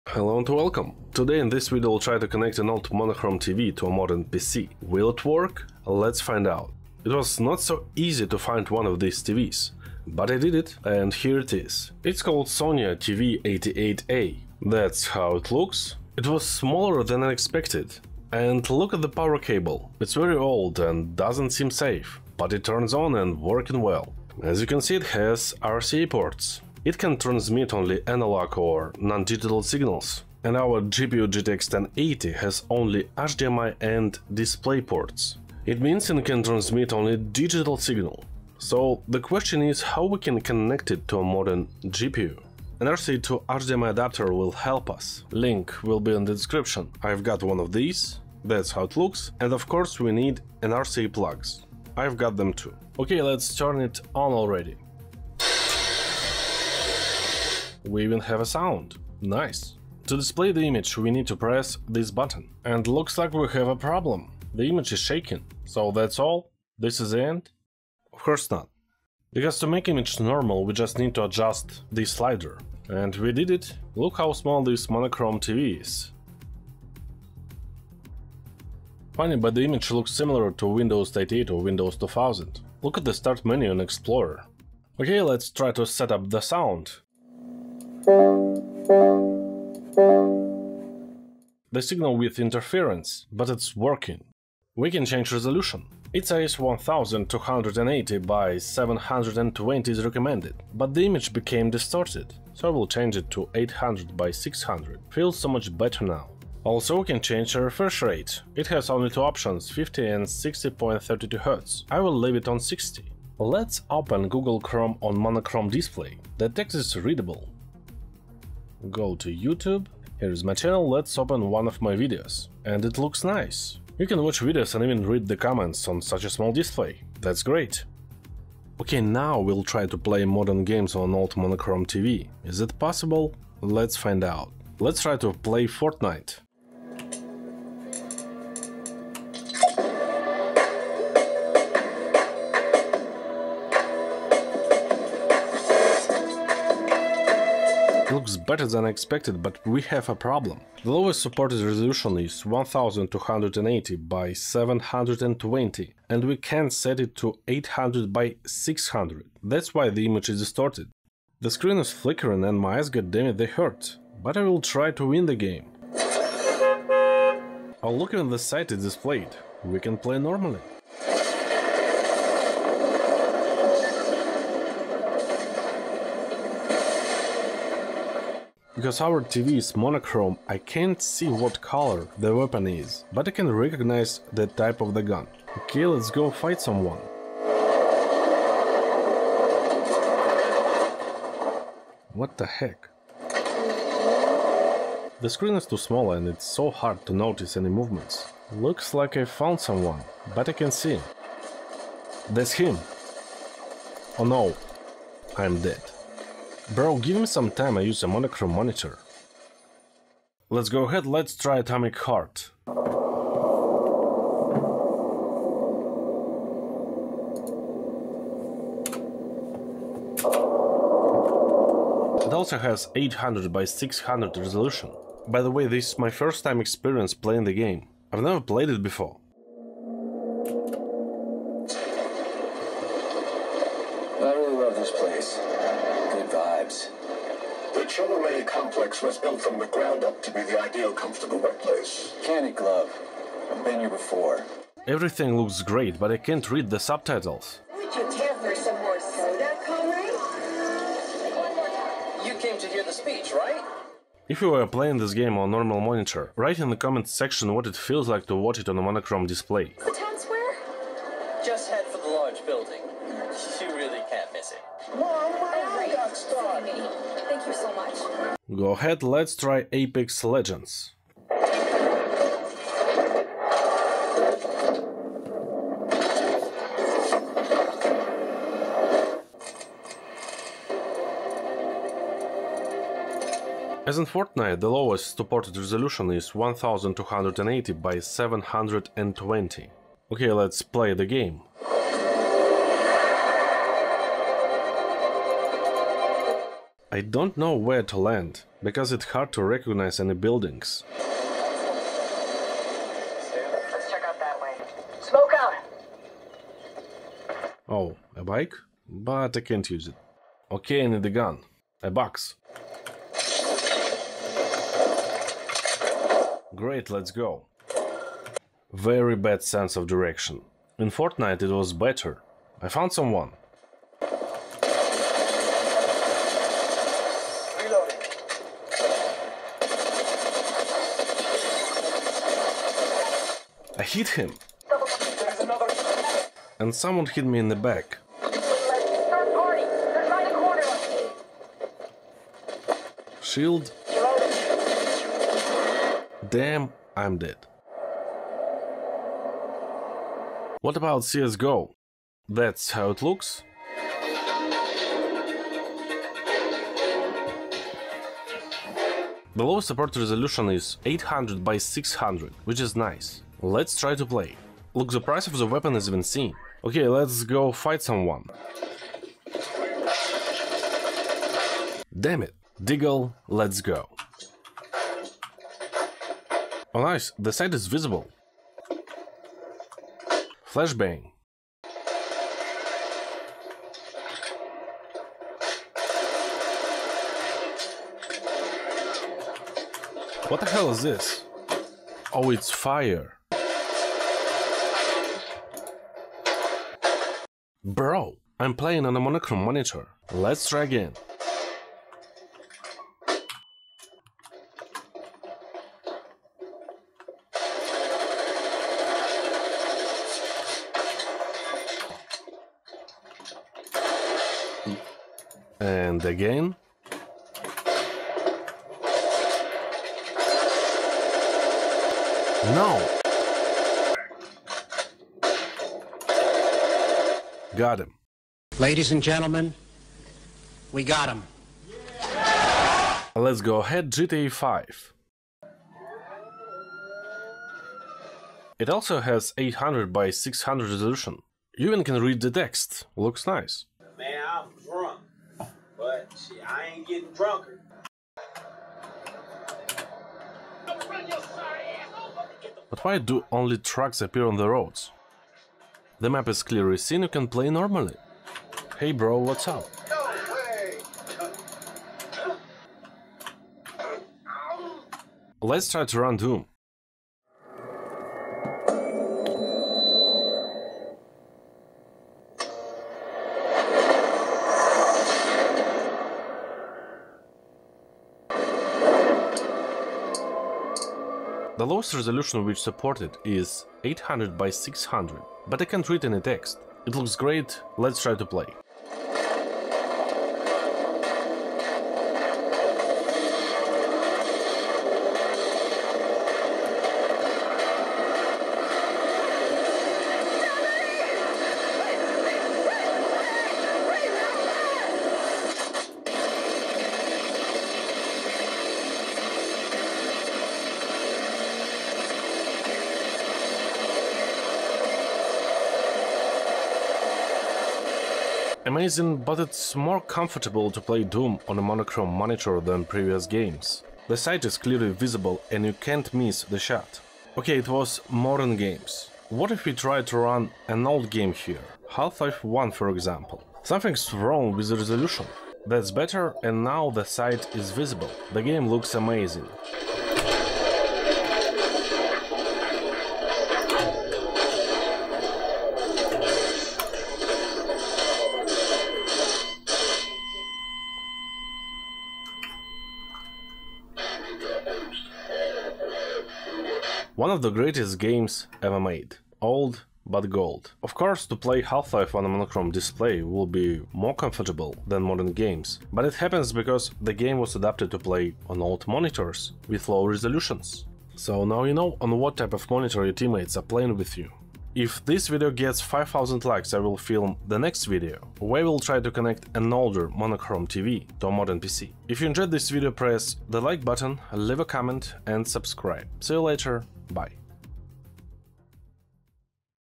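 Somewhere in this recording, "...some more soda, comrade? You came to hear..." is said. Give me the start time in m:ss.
4:08.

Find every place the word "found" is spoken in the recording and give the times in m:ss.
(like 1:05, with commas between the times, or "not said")
3:19, 5:22.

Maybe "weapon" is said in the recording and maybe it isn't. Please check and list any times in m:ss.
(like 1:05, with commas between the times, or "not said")
3:02, 6:05.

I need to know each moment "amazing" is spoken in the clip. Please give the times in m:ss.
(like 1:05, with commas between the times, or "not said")
8:38, 8:58.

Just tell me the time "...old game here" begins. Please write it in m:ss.
8:50.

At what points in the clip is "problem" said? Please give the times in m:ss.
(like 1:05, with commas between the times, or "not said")
1:03, 2:30.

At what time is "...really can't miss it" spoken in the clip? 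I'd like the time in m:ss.
4:23.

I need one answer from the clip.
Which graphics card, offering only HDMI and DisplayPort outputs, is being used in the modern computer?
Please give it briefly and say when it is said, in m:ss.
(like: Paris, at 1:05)
GTX 1080, at 0:31.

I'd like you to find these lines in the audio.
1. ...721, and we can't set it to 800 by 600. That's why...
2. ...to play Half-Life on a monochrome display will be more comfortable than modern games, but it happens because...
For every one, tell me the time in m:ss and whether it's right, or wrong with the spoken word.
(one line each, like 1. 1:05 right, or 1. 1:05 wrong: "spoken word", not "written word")
1. 2:34 wrong: "720", not "721"
2. 9:21 right.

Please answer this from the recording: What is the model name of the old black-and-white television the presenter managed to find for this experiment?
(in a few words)
Sonya TV88A.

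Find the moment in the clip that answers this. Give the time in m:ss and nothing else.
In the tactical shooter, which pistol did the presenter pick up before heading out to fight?
6:12.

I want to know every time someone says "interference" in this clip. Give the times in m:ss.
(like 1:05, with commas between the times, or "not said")
1:32.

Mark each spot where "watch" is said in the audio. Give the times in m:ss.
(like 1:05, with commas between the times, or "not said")
2:04, 4:18.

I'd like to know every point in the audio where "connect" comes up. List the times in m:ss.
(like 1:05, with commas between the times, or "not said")
0:02, 0:40, 9:39.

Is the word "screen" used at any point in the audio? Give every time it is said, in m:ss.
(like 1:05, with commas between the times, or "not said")
2:41, 3:15.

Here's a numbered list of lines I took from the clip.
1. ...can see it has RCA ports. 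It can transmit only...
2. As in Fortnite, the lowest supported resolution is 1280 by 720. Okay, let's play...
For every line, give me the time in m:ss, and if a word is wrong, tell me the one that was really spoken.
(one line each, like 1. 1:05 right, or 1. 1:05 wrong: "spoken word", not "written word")
1. 0:24 right
2. 4:43 right.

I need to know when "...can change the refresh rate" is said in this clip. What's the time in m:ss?
1:47.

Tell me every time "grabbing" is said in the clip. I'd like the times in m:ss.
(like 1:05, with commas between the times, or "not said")
not said.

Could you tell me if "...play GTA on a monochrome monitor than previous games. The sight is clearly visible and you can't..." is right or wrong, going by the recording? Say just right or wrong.
wrong.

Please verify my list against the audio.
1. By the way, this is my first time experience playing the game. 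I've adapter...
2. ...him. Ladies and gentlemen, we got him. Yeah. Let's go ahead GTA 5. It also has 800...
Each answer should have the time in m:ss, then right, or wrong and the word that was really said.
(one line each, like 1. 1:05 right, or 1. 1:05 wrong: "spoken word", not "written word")
1. 3:45 wrong: "never", not "adapter"
2. 7:07 right.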